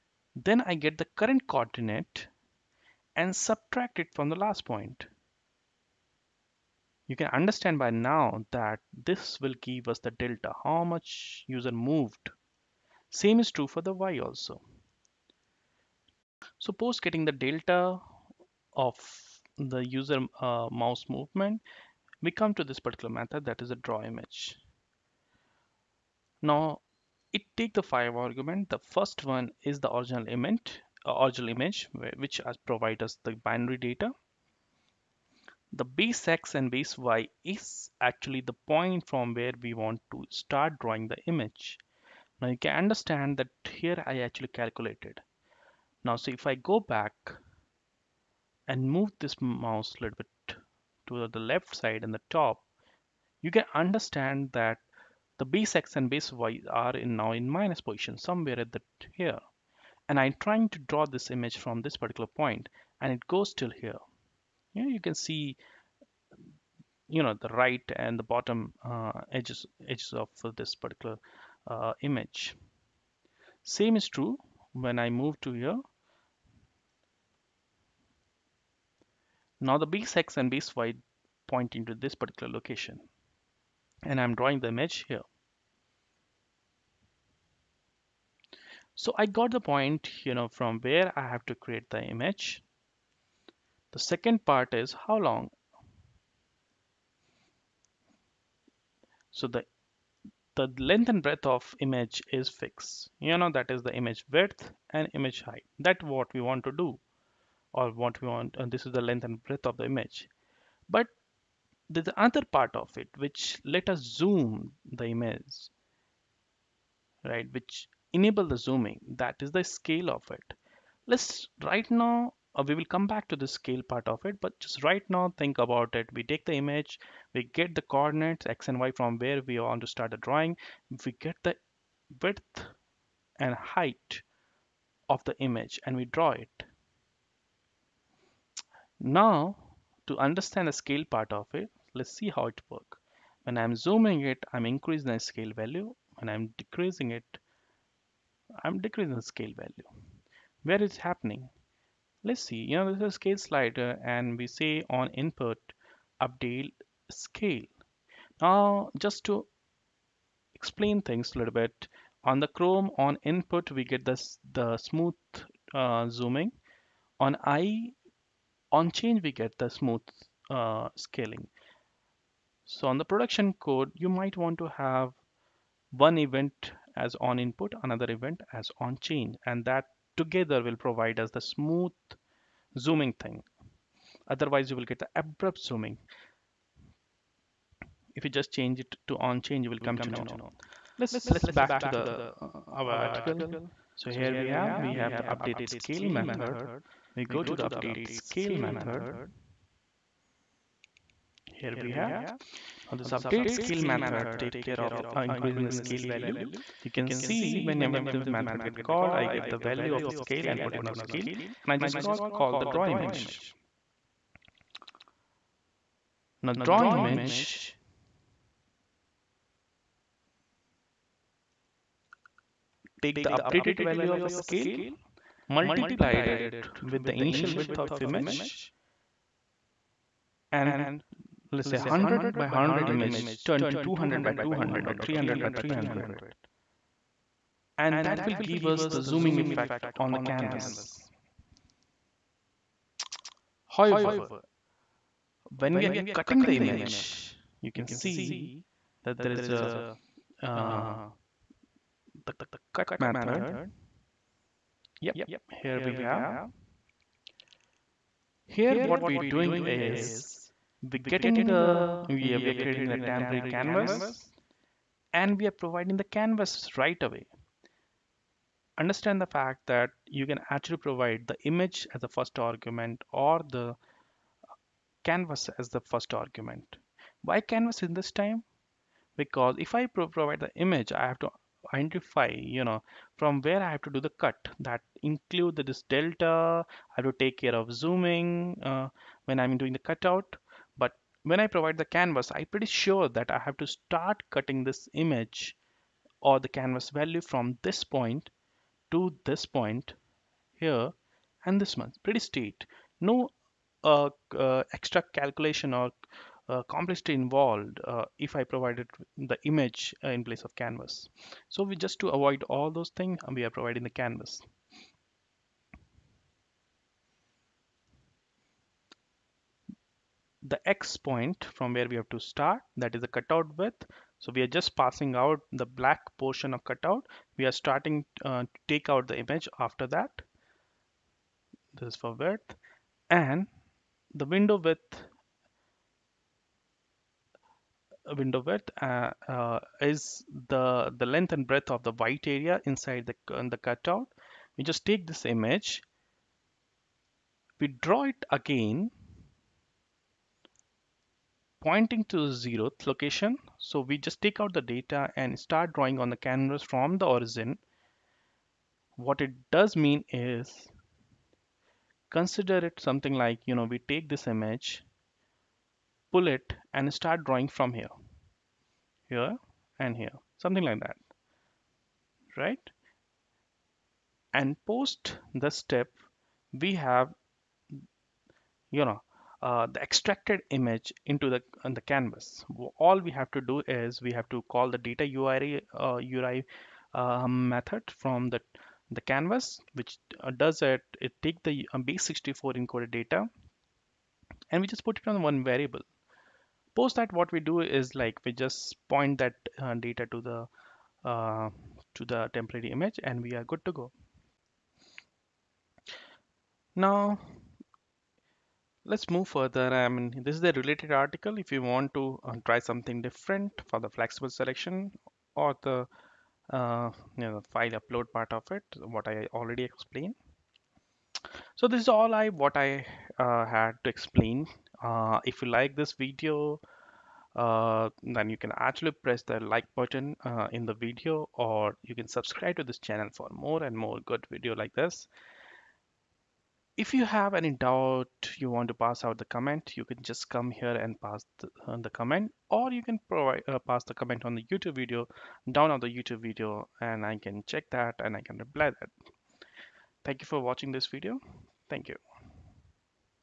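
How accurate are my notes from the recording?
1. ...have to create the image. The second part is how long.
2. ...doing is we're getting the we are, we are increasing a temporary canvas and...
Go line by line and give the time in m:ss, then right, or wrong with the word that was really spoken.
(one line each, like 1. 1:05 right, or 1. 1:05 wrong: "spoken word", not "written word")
1. 1:31 right
2. 4:19 wrong: "creating", not "increasing".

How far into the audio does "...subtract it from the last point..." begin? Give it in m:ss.
0:03.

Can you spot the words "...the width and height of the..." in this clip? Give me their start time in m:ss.
2:11.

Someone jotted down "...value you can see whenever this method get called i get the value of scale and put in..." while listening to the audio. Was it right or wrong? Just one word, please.
right.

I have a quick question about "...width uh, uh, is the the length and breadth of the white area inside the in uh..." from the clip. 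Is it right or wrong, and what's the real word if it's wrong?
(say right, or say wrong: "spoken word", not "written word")
right.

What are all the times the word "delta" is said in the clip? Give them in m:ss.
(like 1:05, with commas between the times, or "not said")
0:10, 0:17, 4:45.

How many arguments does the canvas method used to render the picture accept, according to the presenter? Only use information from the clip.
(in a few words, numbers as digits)
5.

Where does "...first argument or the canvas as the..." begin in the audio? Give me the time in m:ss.
4:32.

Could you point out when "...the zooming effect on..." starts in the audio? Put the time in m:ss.
3:58.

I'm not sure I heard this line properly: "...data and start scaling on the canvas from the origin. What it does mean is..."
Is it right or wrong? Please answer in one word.
wrong.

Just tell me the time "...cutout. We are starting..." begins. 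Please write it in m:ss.
5:26.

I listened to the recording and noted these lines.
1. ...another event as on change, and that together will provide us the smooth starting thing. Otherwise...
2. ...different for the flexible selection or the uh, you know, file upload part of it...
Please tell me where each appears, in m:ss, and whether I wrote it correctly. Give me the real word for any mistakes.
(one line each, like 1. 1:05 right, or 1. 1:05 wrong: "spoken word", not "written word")
1. 2:57 wrong: "zooming", not "starting"
2. 6:53 right.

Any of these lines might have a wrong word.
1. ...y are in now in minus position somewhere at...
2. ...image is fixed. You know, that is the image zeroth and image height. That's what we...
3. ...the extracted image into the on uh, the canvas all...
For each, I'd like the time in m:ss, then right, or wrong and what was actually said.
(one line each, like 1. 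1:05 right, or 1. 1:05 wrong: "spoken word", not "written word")
1. 0:56 right
2. 1:41 wrong: "width", not "zeroth"
3. 6:19 right.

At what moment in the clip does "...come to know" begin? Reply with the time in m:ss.
3:09.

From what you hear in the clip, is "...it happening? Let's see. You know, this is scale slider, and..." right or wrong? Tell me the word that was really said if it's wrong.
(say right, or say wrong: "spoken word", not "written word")
right.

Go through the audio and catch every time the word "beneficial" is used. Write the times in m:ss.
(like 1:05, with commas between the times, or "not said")
not said.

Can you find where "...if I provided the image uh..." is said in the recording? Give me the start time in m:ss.
5:08.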